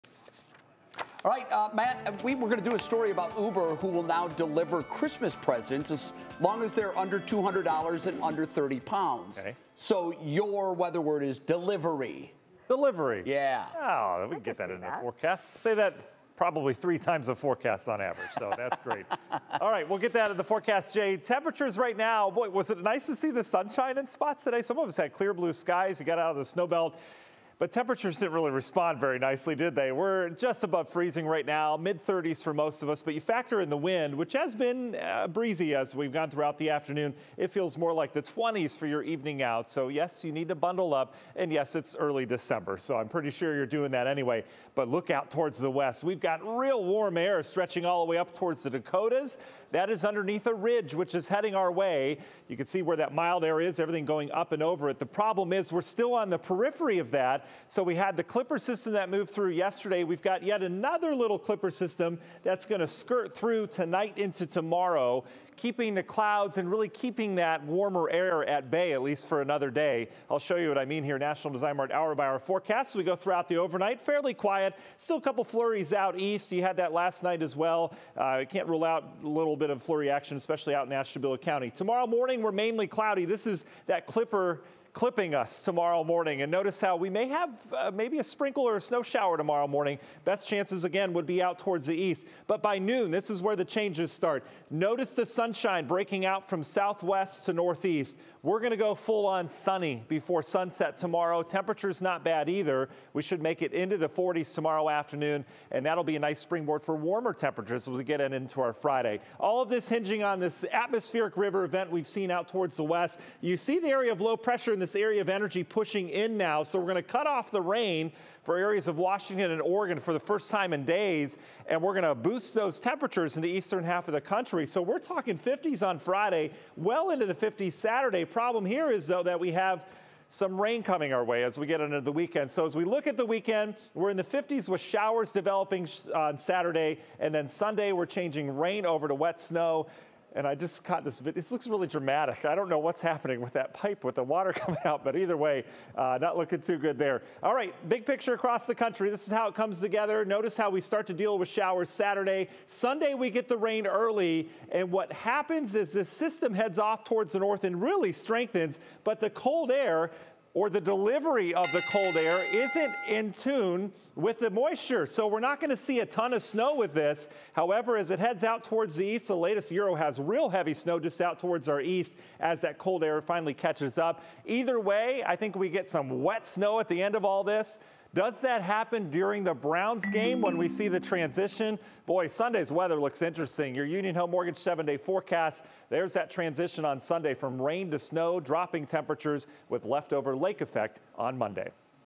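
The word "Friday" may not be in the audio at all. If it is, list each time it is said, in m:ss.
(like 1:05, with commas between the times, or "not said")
1:48, 2:05.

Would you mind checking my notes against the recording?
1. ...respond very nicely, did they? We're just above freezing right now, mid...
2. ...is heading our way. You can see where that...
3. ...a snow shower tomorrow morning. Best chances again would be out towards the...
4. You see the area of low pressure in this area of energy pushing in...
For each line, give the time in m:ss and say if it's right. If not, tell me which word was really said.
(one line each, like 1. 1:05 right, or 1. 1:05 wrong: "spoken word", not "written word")
1. 0:28 right
2. 0:51 right
3. 1:28 right
4. 1:53 right.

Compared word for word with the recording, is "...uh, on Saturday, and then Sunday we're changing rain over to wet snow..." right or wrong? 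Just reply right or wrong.
right.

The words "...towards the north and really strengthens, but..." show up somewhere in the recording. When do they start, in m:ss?
2:37.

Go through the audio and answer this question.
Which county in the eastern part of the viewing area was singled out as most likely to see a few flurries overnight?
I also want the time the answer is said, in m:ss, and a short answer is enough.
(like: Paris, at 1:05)
Ashtabula County, at 1:20.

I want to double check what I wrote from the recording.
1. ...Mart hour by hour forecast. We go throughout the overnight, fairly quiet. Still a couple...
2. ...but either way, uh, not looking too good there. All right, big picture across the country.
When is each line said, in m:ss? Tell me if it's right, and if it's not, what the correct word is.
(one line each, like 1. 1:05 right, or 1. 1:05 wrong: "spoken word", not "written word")
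1. 1:11 right
2. 2:25 right.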